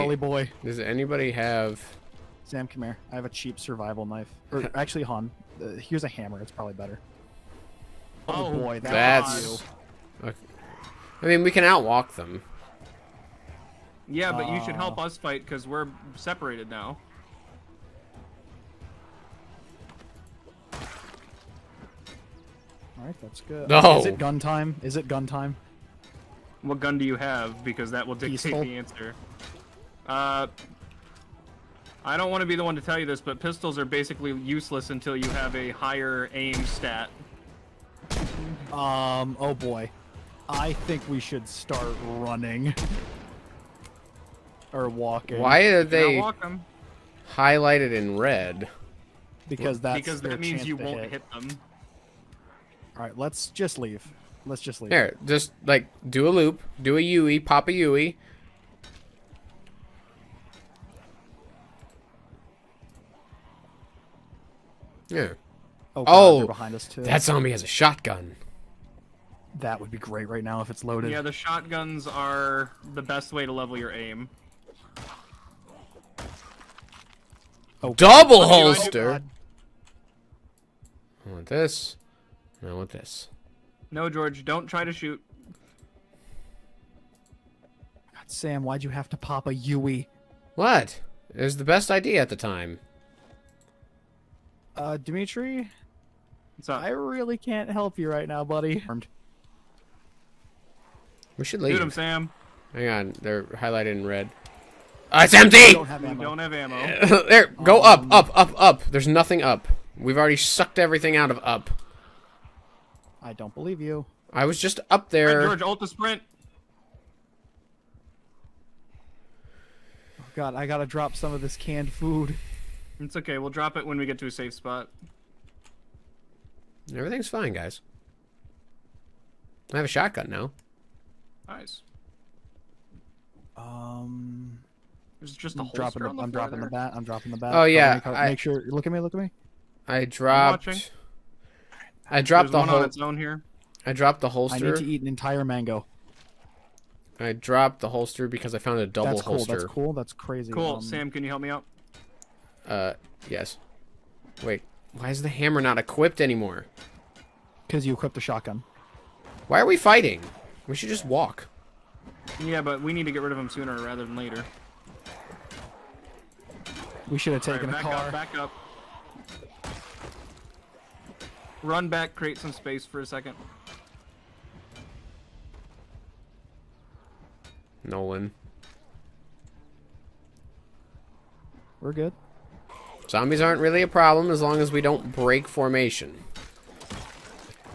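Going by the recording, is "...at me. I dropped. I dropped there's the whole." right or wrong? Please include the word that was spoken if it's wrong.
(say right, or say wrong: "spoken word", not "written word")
right.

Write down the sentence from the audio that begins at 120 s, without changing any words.
Oh god, I gotta drop some of this canned food.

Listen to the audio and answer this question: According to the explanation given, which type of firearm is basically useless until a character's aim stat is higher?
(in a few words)
pistols.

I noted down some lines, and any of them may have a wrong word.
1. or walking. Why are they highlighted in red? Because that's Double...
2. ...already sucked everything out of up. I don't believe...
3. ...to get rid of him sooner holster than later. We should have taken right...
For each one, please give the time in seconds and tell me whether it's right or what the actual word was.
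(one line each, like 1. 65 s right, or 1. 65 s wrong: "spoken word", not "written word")
1. 44 s wrong: "Because", not "Double"
2. 110 s right
3. 163 s wrong: "rather", not "holster".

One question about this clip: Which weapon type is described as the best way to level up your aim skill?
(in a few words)
shotguns.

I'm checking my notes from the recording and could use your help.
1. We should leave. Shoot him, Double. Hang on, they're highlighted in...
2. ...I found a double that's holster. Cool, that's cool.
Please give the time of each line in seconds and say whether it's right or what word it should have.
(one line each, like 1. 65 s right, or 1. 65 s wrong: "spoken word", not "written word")
1. 101 s wrong: "Sam", not "Double"
2. 148 s right.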